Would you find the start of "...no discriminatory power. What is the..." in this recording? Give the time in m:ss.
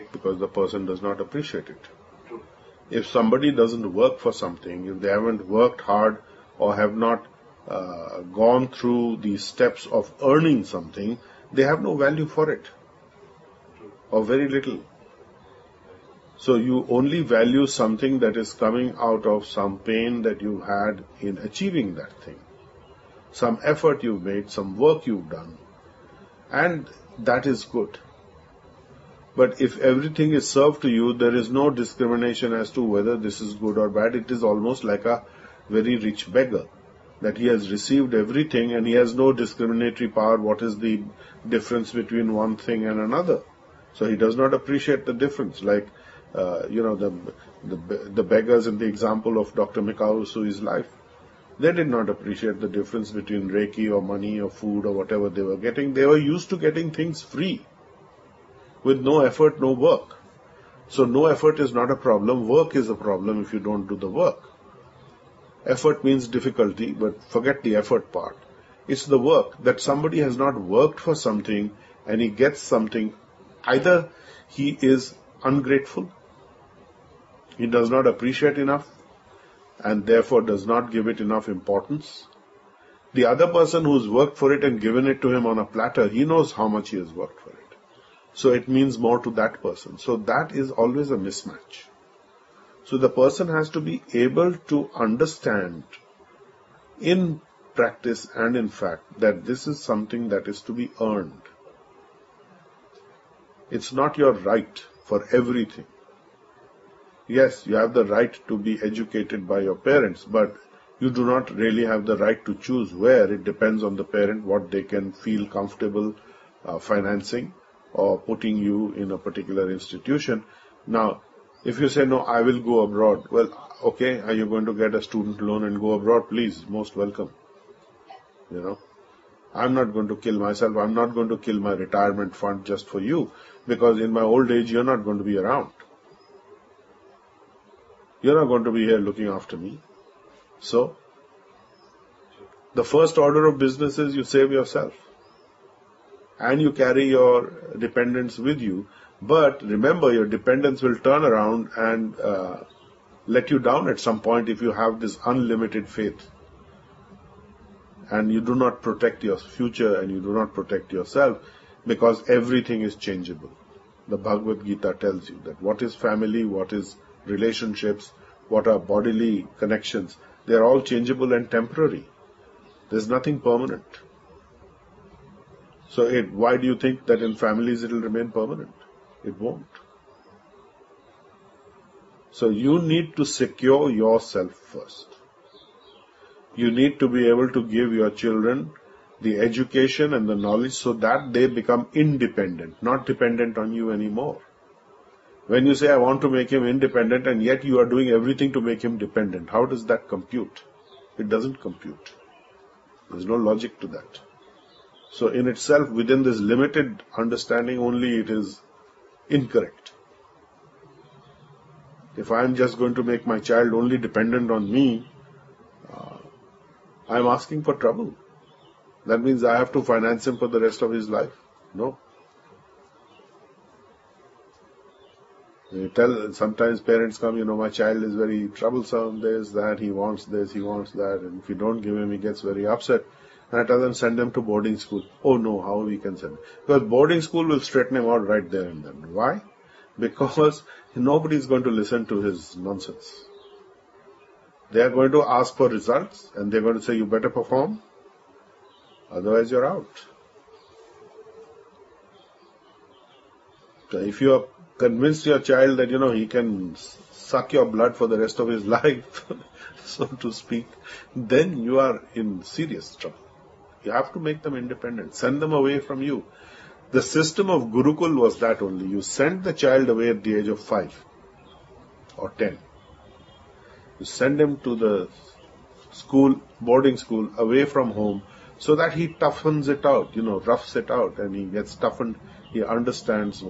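0:39.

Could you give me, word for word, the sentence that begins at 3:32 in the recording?
If I am just going to make my child only dependent on me, uh, I am asking for trouble.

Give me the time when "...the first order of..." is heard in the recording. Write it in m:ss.
2:22.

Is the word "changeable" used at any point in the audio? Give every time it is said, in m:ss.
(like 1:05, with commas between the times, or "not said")
2:42, 2:50.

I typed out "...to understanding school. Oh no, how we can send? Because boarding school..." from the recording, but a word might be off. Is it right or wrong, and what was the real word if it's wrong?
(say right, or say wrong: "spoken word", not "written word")
wrong: "boarding", not "understanding".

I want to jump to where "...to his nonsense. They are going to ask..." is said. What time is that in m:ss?
4:02.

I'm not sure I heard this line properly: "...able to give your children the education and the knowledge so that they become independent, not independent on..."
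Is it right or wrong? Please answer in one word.
wrong.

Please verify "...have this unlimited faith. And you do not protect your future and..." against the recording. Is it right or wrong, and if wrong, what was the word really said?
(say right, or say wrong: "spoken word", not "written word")
right.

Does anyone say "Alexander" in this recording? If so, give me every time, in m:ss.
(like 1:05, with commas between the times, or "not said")
not said.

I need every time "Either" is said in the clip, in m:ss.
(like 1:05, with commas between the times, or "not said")
1:13.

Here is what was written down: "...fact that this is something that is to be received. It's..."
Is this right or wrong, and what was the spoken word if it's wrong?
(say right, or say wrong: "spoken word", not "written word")
wrong: "earned", not "received".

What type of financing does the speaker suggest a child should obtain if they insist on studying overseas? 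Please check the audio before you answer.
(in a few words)
Student loan.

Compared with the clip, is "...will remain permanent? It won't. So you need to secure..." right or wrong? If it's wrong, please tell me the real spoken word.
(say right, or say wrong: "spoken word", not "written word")
right.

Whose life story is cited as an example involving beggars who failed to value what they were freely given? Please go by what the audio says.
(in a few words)
Dr. Mikao Usui.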